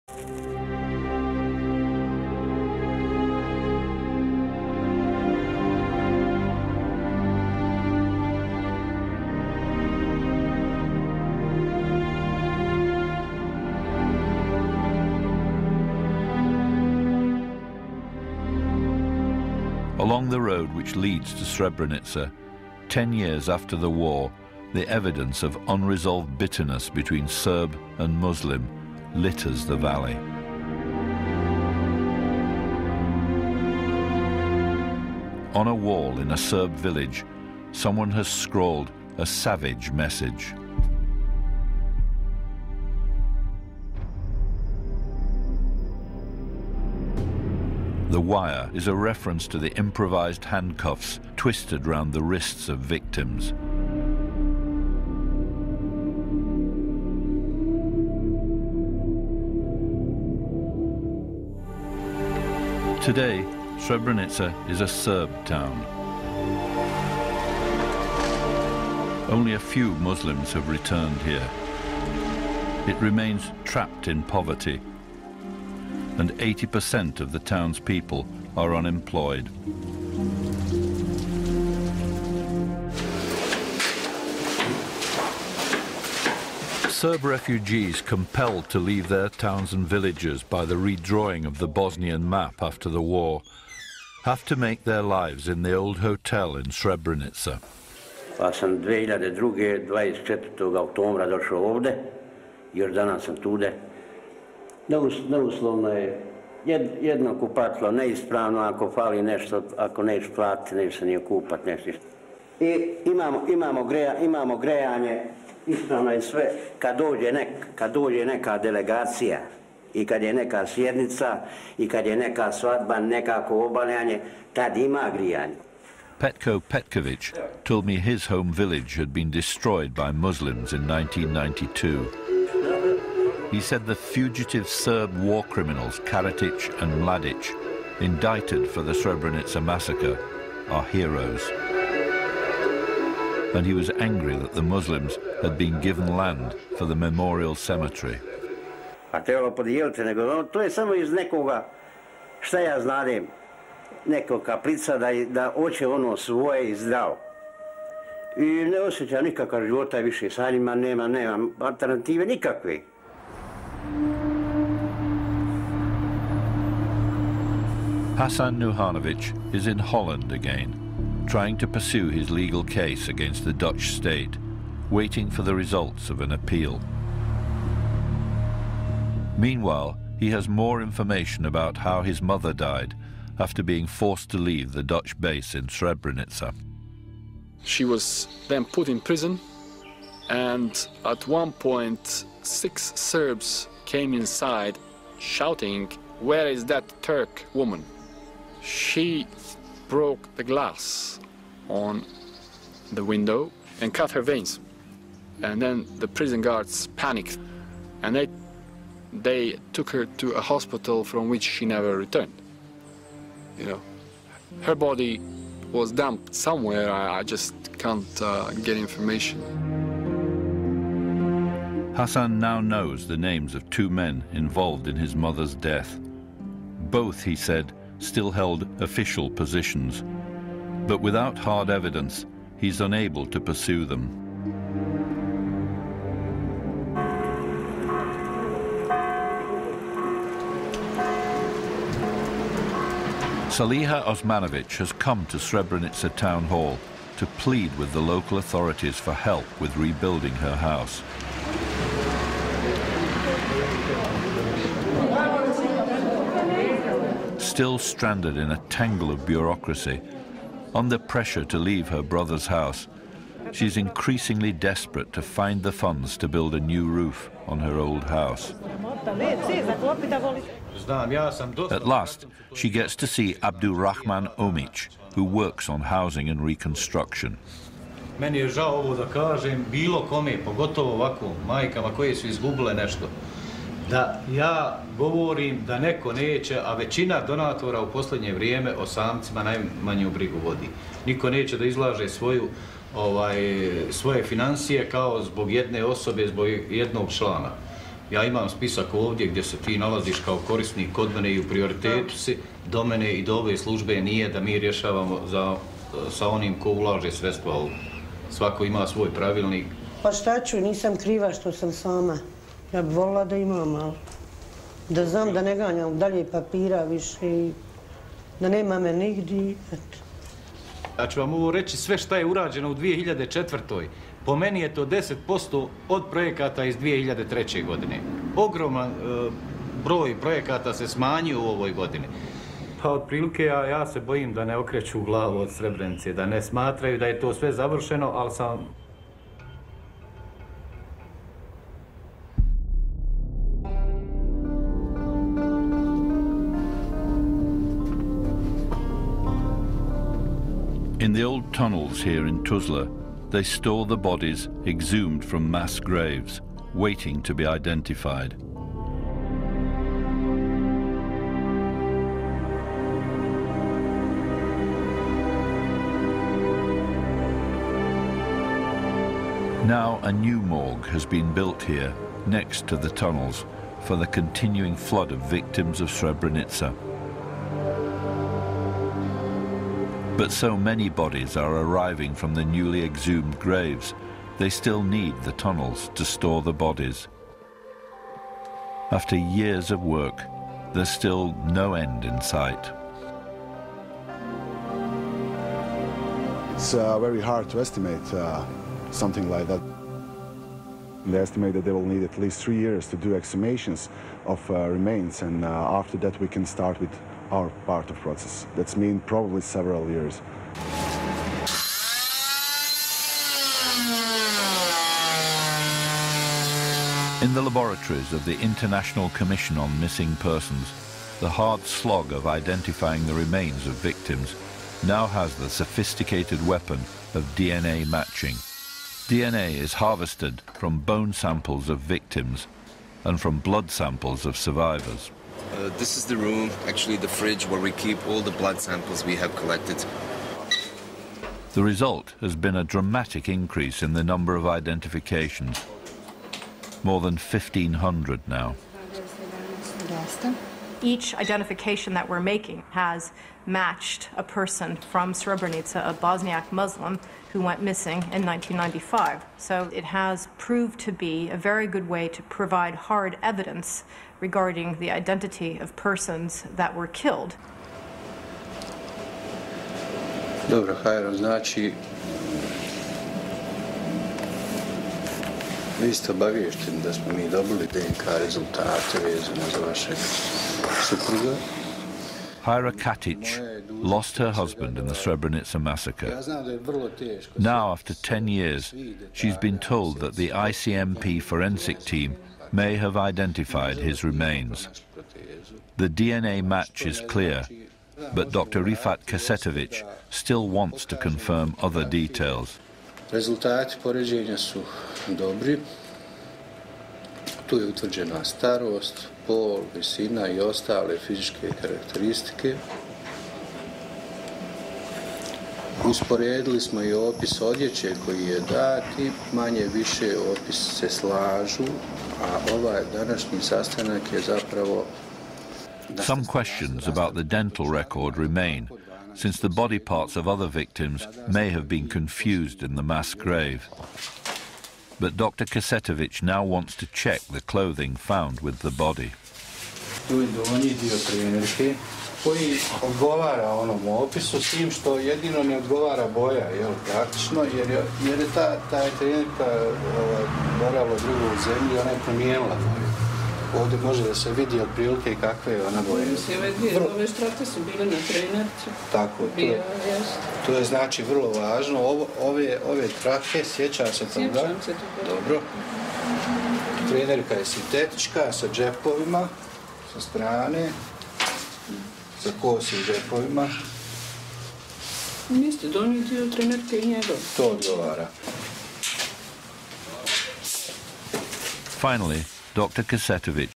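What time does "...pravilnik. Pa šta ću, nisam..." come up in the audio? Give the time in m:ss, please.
5:09.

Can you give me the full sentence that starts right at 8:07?
Now, after 10 years, she's been told that the ICMP forensic team may have identified his remains.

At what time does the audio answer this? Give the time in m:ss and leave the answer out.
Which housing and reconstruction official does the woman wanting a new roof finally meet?
4:33.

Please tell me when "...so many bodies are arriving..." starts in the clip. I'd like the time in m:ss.
6:20.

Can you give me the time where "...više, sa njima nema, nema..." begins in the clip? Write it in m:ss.
2:39.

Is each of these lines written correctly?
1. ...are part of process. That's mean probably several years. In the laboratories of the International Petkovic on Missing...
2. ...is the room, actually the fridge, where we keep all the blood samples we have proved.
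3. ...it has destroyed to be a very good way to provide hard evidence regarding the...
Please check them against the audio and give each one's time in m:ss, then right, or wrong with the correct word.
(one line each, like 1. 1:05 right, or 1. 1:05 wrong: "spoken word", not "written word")
1. 6:47 wrong: "Commission", not "Petkovic"
2. 7:15 wrong: "collected", not "proved"
3. 7:39 wrong: "proved", not "destroyed".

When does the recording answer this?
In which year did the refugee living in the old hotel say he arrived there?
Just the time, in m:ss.
1:38.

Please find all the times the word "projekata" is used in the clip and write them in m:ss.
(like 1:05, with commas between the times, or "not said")
5:26, 5:30.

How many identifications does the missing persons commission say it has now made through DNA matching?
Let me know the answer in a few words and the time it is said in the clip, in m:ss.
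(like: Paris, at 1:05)
more than 1,500, at 7:26.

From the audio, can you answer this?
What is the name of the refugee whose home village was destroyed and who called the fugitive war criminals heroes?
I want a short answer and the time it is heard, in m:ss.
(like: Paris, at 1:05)
Petko Petkovic, at 2:06.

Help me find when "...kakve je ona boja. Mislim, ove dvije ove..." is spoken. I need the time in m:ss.
9:15.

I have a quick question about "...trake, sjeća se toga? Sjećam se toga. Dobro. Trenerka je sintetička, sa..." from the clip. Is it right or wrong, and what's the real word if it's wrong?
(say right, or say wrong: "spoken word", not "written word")
right.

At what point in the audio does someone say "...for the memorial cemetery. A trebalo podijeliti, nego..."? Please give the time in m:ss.
2:26.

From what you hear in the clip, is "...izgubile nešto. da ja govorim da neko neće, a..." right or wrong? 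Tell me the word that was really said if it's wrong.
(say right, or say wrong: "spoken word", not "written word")
right.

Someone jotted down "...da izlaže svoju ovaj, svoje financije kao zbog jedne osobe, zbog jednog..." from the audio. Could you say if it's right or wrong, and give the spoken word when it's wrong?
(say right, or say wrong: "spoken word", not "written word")
right.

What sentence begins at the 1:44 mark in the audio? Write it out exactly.
neus, neuslovno je jedno kupatlo, neispravno ako fali nešto, ako neš platiti, neš se nije kupat, neš ništa.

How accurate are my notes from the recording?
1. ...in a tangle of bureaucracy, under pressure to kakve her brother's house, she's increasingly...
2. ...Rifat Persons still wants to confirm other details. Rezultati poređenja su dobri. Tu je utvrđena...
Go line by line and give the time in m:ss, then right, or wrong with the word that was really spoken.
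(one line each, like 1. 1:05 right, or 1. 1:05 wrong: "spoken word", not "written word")
1. 4:18 wrong: "leave", not "kakve"
2. 8:18 wrong: "Kesetovic", not "Persons".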